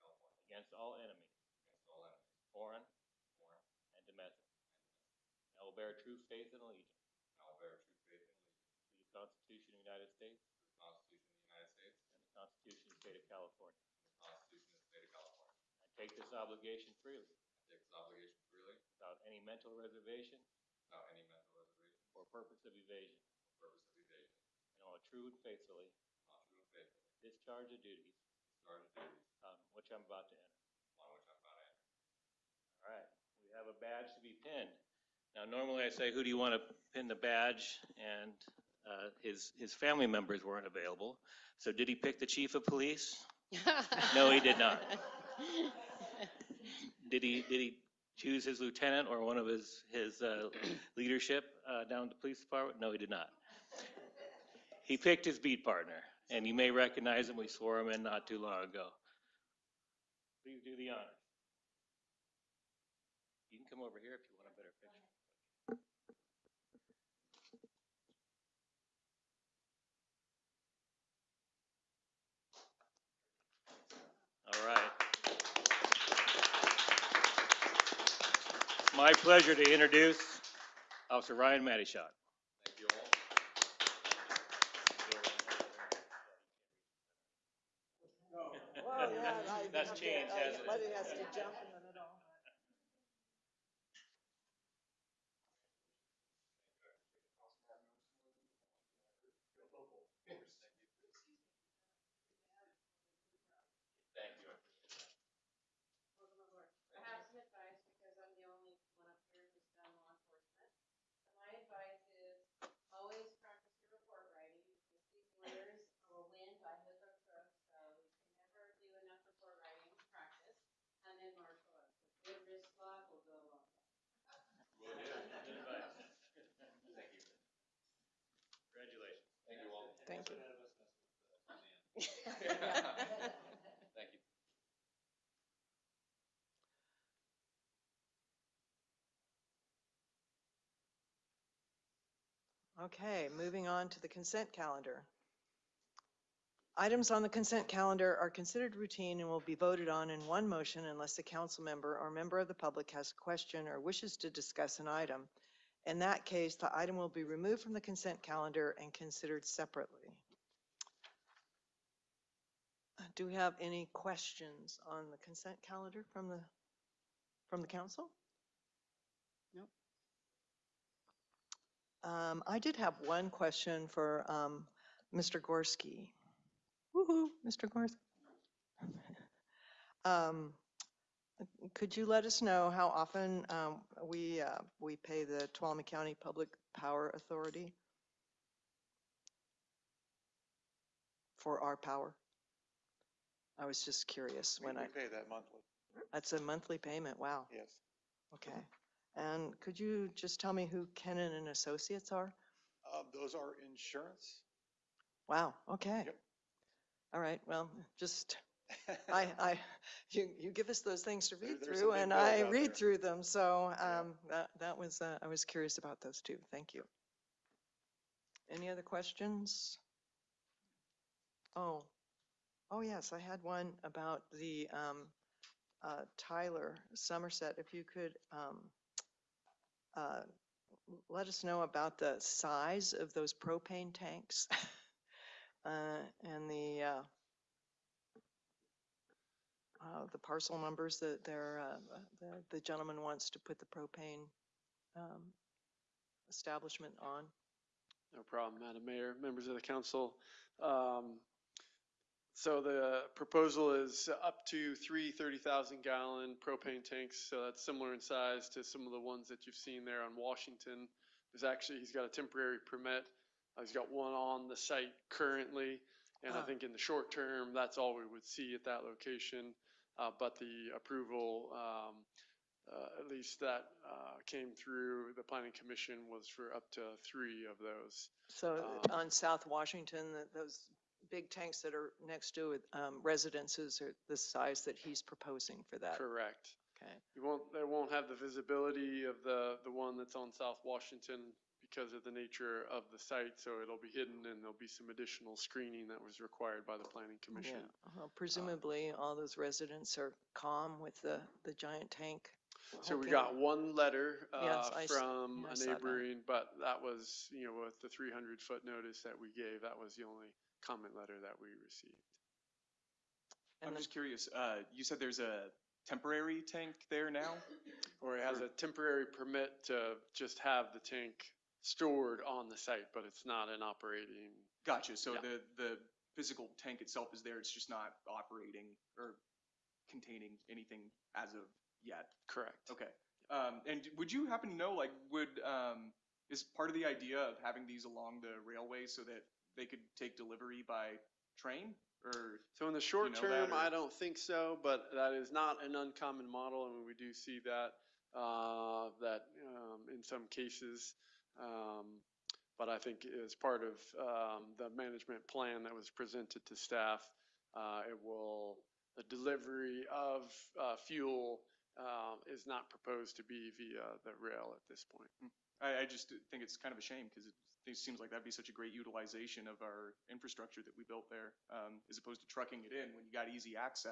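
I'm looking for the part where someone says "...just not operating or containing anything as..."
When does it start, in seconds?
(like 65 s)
327 s.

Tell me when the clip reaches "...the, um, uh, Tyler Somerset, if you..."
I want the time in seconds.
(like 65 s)
224 s.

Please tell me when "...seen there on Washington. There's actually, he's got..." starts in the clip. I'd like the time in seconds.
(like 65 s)
259 s.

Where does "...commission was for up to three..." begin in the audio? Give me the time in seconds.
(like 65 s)
275 s.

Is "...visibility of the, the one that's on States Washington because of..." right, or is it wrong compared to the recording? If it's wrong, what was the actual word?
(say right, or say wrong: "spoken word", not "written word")
wrong: "South", not "States".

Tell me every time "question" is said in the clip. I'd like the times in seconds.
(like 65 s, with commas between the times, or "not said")
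153 s, 163 s, 173 s, 218 s.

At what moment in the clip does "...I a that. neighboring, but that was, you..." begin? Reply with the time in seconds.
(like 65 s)
305 s.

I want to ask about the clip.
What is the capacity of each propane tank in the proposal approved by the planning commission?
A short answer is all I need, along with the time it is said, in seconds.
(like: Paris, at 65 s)
30,000 gallons, at 255 s.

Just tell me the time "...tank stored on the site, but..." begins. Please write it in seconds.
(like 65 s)
320 s.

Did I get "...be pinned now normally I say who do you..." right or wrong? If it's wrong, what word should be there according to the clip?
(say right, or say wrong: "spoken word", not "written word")
right.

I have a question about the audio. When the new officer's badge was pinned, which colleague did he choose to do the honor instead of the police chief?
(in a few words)
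His beat partner.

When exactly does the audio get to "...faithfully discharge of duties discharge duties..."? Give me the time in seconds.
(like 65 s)
26 s.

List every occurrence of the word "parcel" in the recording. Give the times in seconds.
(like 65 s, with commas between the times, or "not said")
240 s.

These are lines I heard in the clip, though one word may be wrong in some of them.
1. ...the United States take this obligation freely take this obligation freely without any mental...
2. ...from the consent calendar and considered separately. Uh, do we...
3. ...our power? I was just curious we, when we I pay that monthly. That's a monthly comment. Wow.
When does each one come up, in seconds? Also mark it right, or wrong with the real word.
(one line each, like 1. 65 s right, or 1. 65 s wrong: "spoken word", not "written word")
1. 9 s right
2. 157 s right
3. 191 s wrong: "payment", not "comment".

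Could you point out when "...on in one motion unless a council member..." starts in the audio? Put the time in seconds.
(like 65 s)
149 s.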